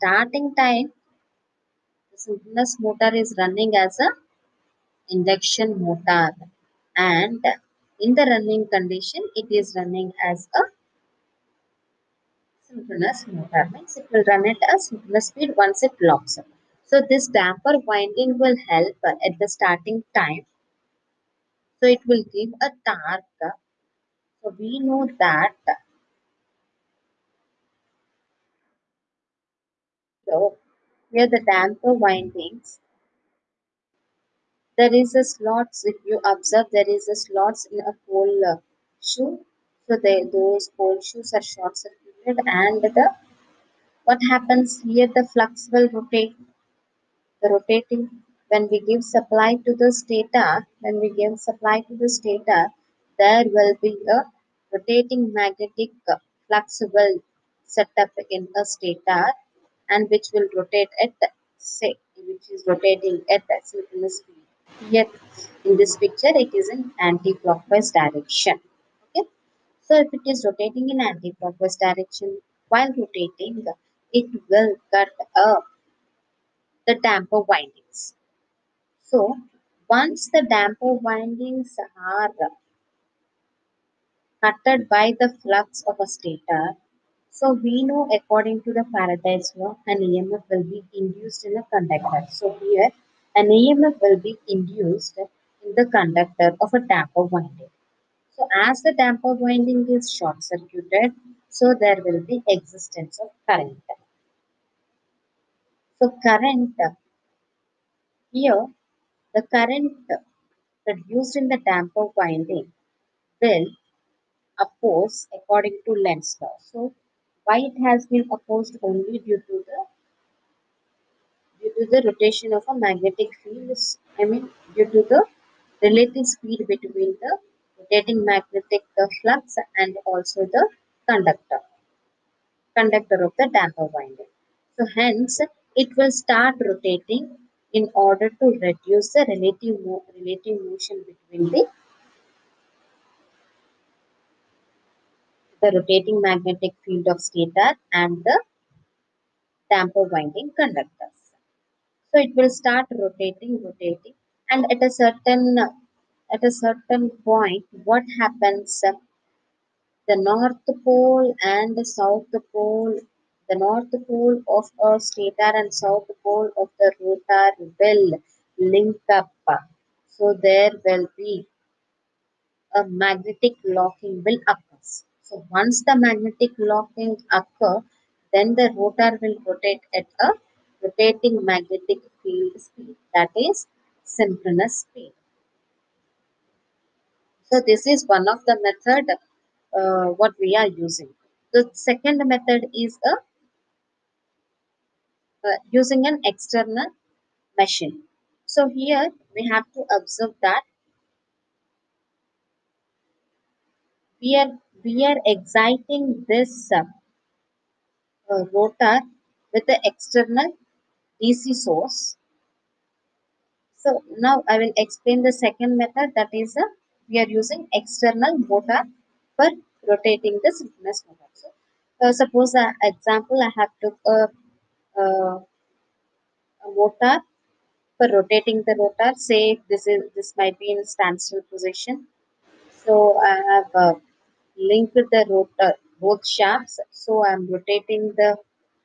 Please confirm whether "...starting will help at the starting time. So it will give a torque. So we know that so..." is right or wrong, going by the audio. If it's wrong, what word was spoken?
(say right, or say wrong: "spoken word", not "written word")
wrong: "winding", not "starting".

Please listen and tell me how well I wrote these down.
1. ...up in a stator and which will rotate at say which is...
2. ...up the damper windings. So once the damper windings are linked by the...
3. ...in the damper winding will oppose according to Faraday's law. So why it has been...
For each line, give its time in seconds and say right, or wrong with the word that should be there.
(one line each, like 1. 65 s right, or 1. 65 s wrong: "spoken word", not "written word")
1. 58 s right
2. 75 s wrong: "cutted", not "linked"
3. 111 s wrong: "Lenz", not "Faraday".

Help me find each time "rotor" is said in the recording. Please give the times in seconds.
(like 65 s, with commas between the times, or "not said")
167 s, 178 s, 208 s, 228 s, 235 s.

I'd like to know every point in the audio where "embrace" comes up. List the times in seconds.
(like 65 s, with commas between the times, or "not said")
not said.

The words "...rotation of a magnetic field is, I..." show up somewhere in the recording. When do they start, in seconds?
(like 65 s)
122 s.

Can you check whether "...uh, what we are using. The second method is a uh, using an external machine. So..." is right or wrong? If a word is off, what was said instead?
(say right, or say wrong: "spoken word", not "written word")
right.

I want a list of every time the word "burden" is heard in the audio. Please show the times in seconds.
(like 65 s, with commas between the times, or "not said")
not said.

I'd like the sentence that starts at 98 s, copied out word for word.
So as the damper winding is short circuited, so there will be existence of current.